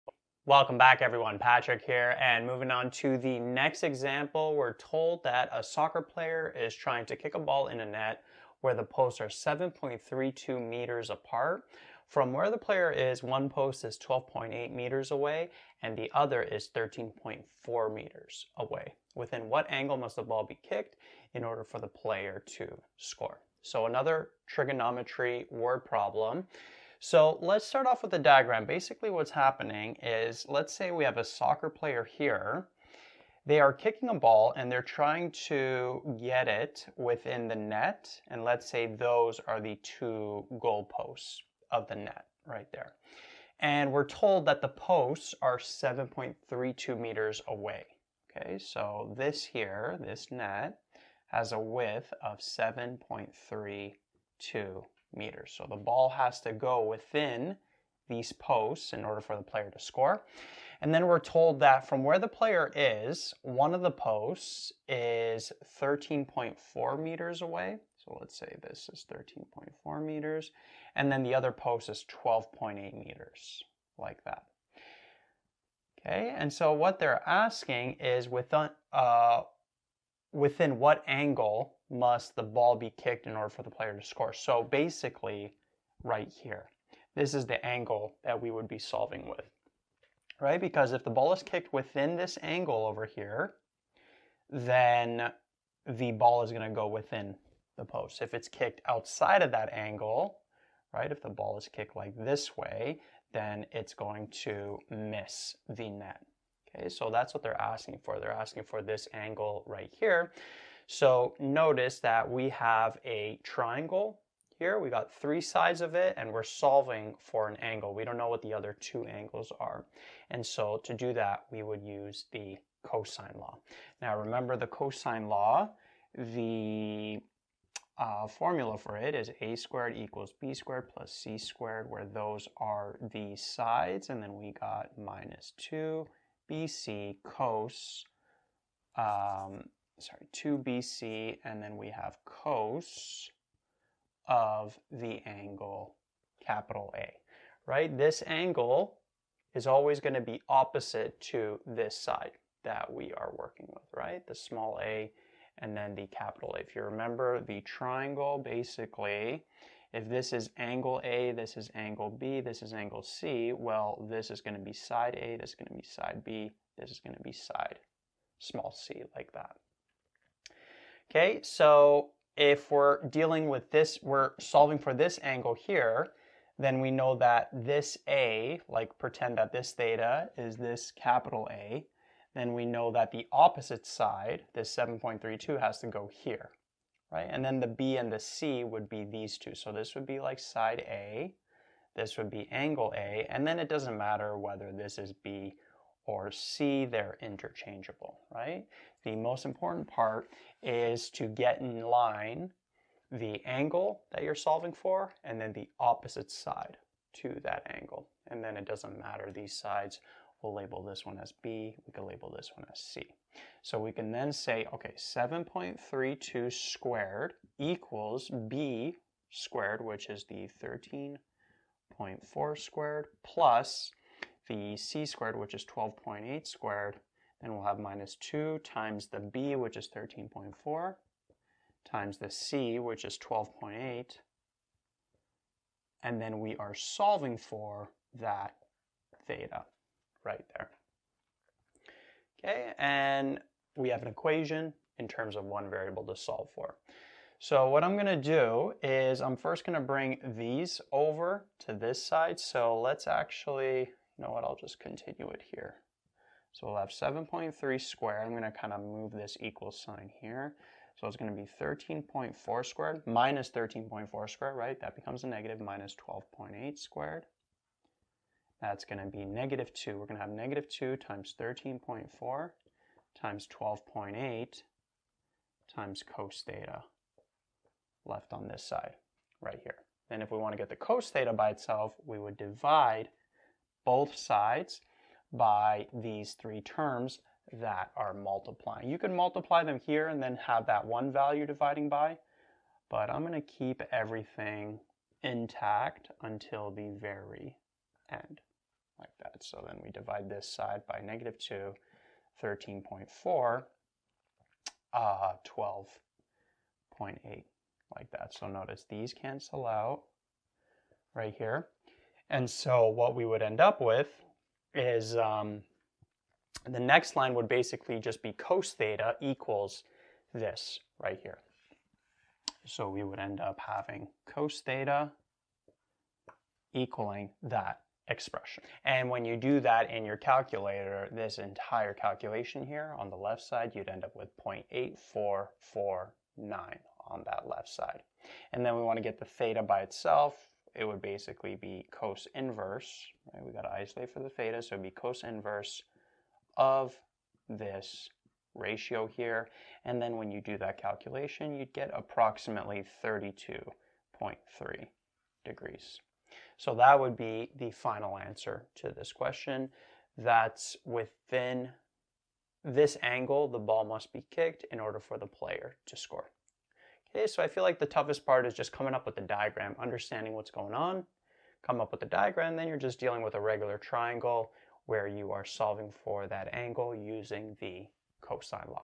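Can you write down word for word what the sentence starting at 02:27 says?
This angle is always going to be opposite to this side that we are working with, right?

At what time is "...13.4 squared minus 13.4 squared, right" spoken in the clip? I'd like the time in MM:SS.
04:21.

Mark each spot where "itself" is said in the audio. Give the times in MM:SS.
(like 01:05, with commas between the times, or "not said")
04:41, 05:39.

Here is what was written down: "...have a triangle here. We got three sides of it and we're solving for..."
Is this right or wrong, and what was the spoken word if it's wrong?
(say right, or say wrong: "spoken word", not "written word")
right.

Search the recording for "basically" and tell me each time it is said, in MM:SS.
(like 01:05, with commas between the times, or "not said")
00:28, 01:24, 02:38, 05:17, 05:41.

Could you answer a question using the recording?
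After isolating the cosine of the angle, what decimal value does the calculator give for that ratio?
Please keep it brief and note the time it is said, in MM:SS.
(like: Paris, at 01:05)
0.8449, at 05:34.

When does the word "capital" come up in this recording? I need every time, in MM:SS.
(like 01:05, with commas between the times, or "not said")
02:26, 02:36, 03:00.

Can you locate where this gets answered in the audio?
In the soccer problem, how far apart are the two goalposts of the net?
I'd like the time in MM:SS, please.
00:09.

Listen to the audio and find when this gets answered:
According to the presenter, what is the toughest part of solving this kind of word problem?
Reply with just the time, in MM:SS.
06:08.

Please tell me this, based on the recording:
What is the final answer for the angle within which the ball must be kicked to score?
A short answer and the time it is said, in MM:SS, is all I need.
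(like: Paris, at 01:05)
32.3 degrees, at 05:53.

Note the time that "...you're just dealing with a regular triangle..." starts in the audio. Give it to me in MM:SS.
06:12.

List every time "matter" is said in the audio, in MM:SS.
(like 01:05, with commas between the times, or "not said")
03:13, 03:28.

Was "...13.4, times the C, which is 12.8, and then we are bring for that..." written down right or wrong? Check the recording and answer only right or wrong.
wrong.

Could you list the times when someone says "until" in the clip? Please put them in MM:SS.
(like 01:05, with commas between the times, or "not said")
04:56.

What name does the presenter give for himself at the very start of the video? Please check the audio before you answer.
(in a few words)
Patrick.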